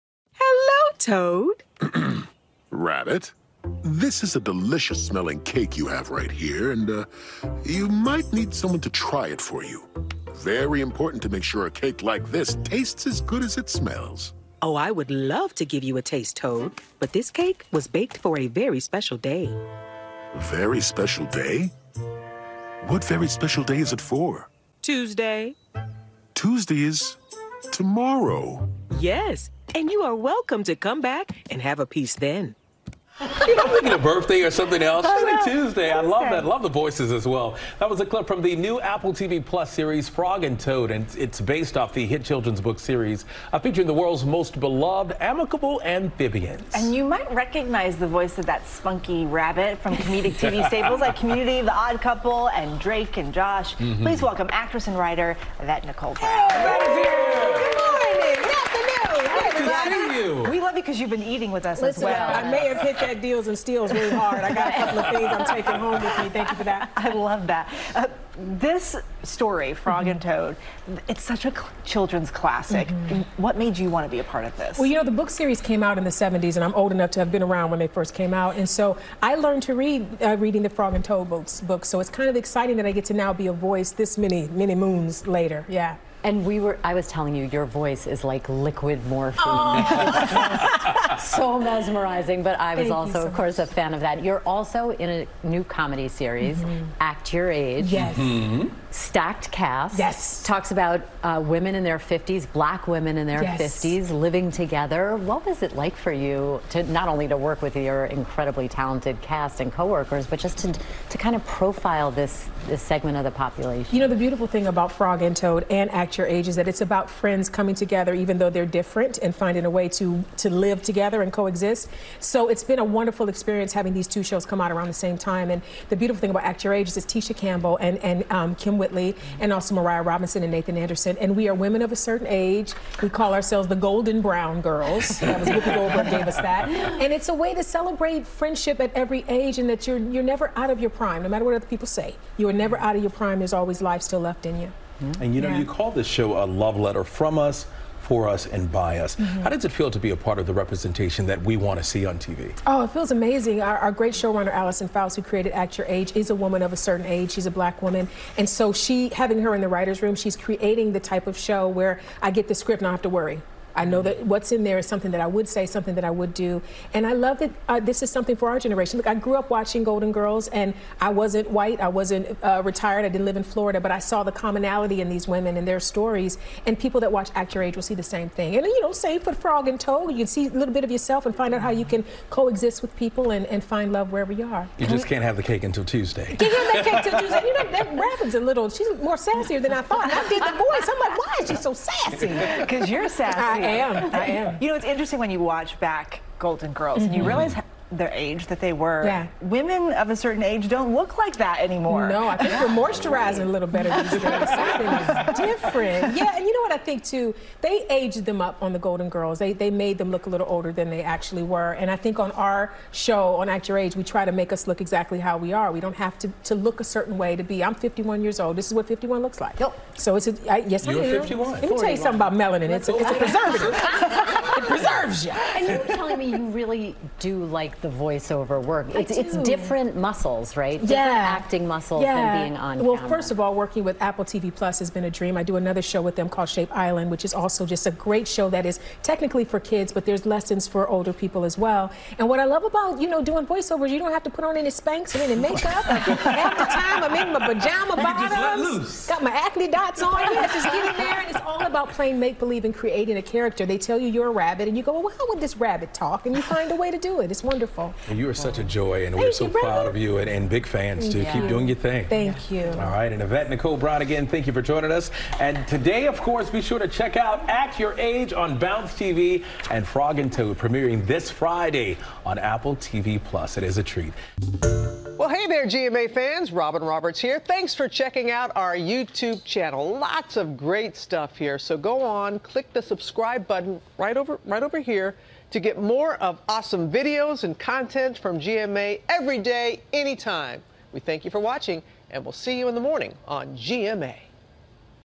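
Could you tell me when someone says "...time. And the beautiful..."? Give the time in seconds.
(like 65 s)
125 s.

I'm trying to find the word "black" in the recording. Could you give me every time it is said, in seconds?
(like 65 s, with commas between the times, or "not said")
102 s, 157 s.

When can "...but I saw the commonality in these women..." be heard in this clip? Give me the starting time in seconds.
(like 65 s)
173 s.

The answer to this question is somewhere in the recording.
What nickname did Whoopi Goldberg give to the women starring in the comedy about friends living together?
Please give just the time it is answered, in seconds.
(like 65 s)
133 s.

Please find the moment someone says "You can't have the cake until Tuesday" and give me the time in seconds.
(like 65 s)
186 s.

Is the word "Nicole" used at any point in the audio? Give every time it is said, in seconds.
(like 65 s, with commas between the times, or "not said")
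55 s, 263 s.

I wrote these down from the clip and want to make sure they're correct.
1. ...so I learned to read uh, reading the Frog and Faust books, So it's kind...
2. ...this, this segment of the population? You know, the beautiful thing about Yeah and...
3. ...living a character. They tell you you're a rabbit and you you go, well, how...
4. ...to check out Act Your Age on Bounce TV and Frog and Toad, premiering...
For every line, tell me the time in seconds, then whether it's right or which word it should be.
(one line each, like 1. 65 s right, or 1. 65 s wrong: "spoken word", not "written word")
1. 78 s wrong: "Toad", not "Faust"
2. 112 s wrong: "Frog", not "Yeah"
3. 252 s wrong: "creating", not "living"
4. 266 s right.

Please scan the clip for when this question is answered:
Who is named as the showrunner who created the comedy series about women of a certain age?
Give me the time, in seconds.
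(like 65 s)
154 s.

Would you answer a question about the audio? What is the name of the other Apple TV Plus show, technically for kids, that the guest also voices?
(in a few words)
Shape Island.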